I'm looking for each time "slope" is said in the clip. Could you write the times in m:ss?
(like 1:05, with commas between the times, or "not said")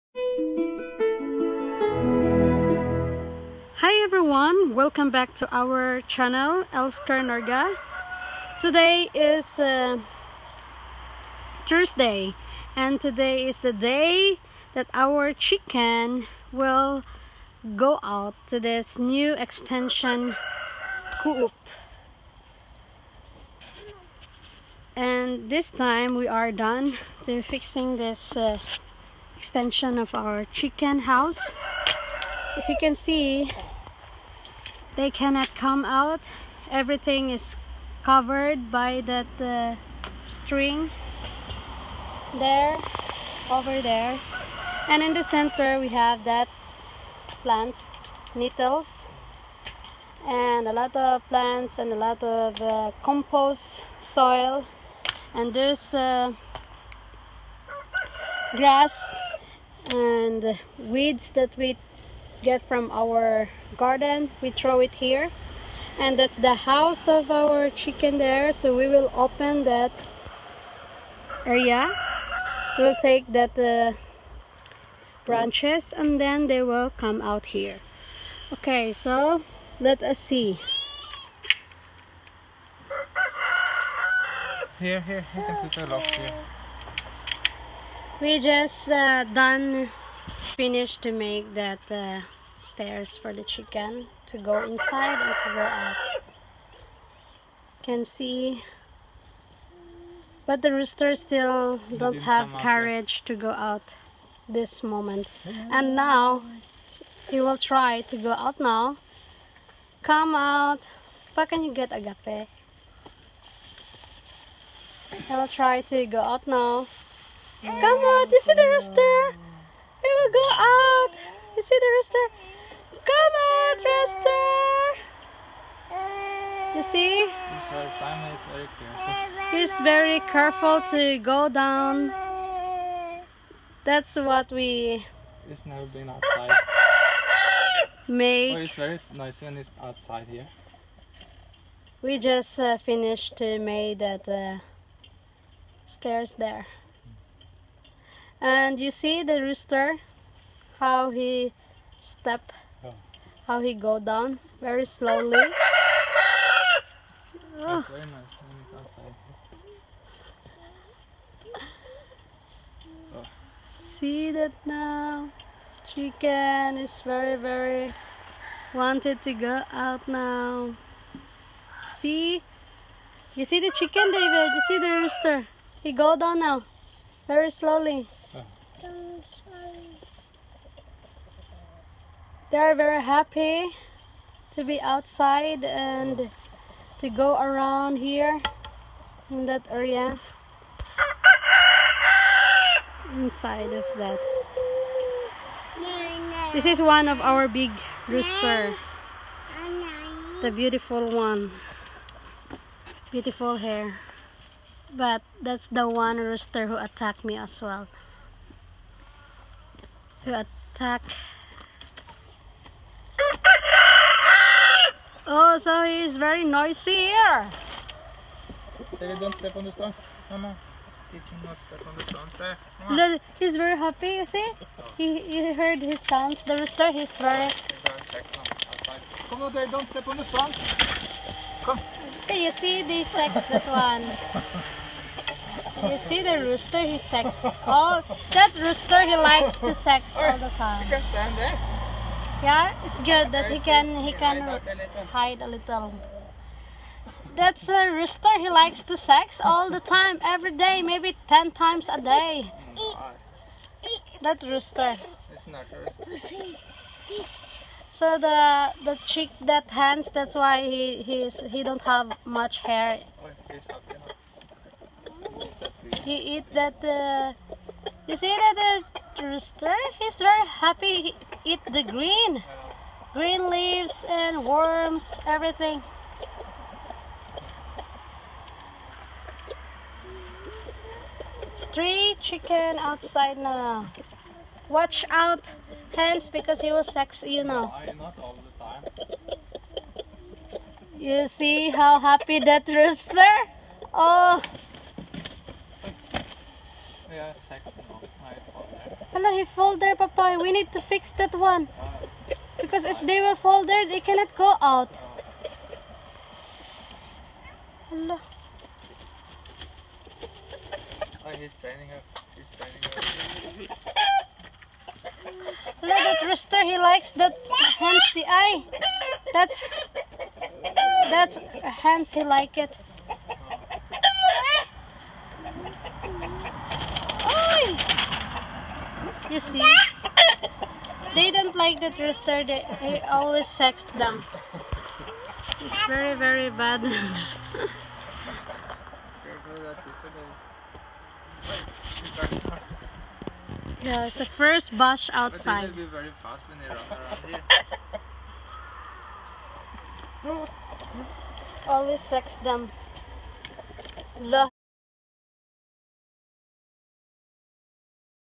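not said.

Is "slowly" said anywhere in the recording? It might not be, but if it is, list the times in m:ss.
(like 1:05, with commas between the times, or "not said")
2:34, 2:57.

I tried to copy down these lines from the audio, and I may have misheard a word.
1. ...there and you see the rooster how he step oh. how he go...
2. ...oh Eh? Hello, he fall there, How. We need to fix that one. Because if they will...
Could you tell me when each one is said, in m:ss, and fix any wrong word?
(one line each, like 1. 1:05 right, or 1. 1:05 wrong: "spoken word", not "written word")
1. 2:26 right
2. 4:53 wrong: "Papoy", not "How".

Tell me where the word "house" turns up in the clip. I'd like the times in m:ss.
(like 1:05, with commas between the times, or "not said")
0:30, 1:06.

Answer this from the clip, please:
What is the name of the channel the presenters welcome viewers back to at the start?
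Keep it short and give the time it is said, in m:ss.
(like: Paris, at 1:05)
Elsker Norga, at 0:06.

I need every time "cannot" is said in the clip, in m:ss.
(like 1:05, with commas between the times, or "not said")
0:35, 3:41, 5:03.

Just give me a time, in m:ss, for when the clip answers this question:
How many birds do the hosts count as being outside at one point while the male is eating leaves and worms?
4:41.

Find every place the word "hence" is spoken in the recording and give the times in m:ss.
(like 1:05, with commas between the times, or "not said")
5:17, 5:21.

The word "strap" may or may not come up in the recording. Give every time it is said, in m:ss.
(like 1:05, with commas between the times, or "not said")
not said.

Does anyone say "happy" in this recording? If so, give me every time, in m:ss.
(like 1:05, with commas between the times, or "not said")
3:03, 3:43, 4:30, 4:51.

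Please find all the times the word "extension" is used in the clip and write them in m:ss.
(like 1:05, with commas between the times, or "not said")
0:19, 0:29.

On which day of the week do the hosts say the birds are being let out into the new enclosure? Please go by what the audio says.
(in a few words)
Thursday.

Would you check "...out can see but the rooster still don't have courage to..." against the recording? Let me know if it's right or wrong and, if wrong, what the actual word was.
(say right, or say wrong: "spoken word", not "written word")
right.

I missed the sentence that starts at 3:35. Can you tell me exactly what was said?
Oh, sorry, it's very noisy here.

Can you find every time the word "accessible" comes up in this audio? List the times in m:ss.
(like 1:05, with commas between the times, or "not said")
not said.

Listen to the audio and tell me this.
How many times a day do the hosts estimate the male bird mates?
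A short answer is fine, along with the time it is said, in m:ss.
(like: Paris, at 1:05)
10, at 4:11.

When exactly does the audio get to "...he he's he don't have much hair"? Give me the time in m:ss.
4:20.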